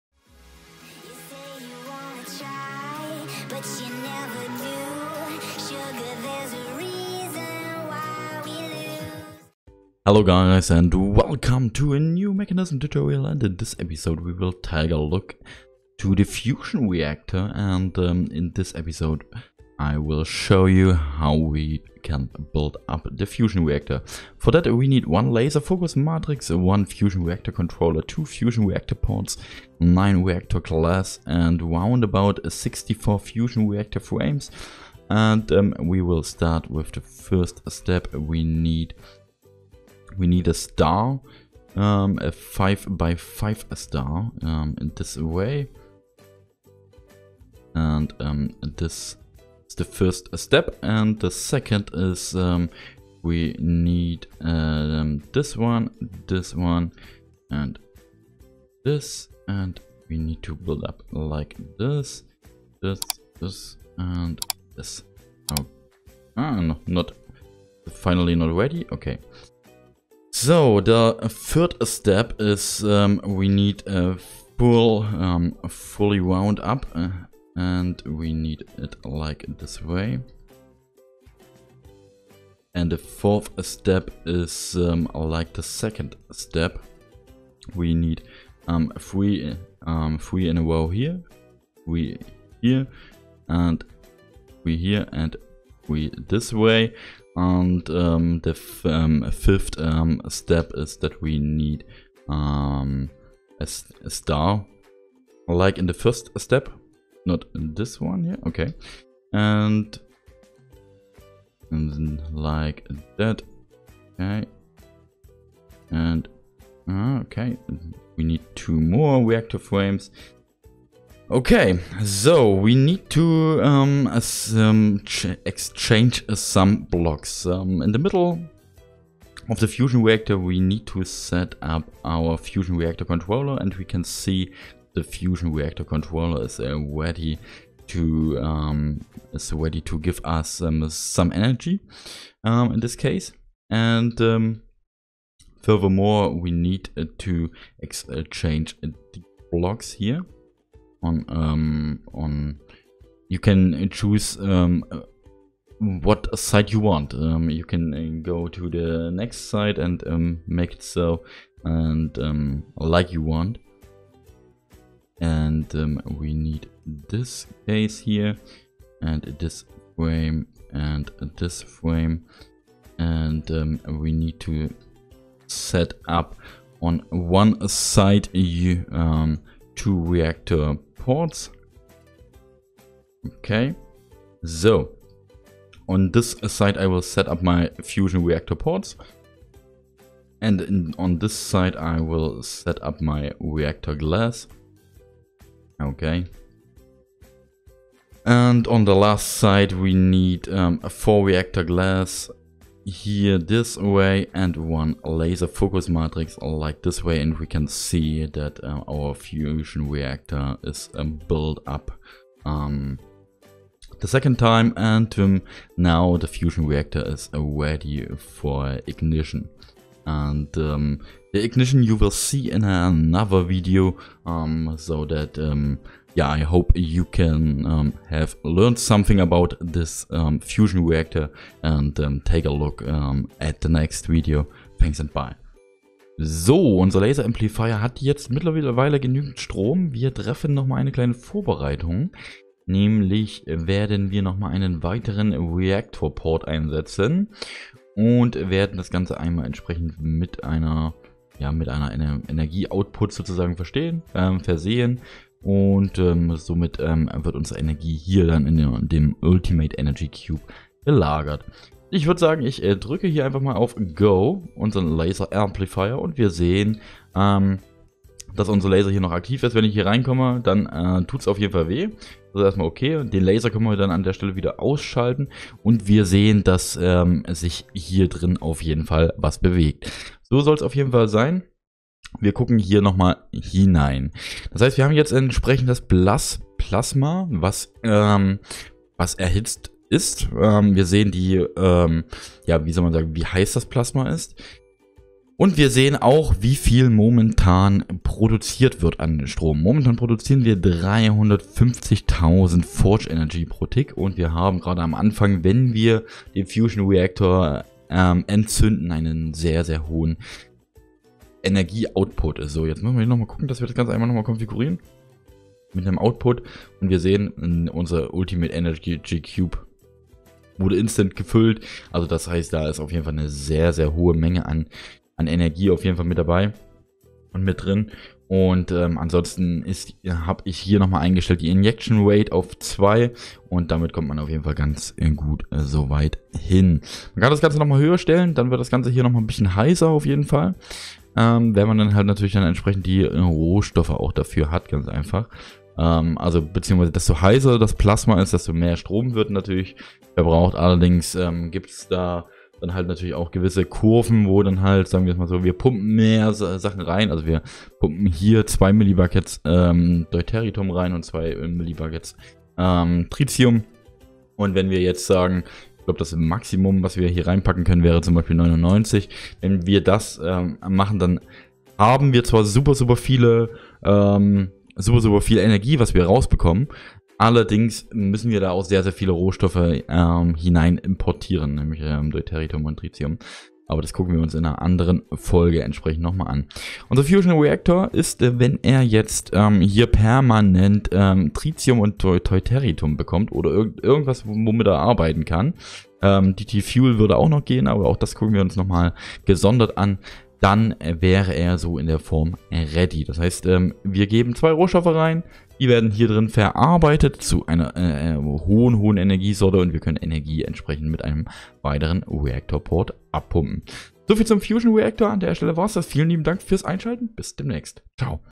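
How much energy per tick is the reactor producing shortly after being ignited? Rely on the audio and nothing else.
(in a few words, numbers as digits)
350,000 Forge Energy.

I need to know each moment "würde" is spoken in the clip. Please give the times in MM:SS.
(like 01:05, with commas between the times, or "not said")
04:22, 06:36.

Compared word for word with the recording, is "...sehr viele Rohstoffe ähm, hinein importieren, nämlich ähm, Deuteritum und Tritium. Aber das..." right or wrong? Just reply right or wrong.
right.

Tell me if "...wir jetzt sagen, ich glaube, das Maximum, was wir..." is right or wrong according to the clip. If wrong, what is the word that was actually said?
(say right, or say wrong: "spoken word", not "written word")
right.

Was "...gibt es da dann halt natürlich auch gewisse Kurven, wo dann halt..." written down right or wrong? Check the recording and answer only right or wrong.
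right.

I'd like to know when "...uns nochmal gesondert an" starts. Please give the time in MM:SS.
06:38.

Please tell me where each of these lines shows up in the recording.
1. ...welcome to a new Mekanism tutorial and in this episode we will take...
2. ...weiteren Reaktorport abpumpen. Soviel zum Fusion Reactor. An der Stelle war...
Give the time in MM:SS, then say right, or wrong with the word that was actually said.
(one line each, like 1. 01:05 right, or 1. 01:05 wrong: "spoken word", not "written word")
1. 00:11 right
2. 06:51 right.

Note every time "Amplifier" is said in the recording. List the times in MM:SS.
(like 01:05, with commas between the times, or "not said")
03:57, 04:25.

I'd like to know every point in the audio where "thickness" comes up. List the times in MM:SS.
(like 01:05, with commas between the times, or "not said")
not said.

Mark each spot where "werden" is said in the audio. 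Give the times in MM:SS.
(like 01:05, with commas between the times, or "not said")
04:03, 04:08, 06:45.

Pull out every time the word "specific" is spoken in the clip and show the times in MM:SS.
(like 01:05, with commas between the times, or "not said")
not said.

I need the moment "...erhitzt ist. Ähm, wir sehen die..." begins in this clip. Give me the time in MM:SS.
04:49.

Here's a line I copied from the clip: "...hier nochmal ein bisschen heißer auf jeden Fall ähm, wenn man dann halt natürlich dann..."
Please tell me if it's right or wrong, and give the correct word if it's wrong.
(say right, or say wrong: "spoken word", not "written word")
right.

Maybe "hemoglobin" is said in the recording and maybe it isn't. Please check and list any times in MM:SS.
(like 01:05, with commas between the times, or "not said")
not said.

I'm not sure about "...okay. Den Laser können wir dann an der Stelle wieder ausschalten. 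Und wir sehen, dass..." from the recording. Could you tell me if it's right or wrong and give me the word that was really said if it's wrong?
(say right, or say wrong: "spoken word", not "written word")
right.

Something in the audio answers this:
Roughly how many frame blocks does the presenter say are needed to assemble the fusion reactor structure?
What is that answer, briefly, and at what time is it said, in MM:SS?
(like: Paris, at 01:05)
64, at 00:32.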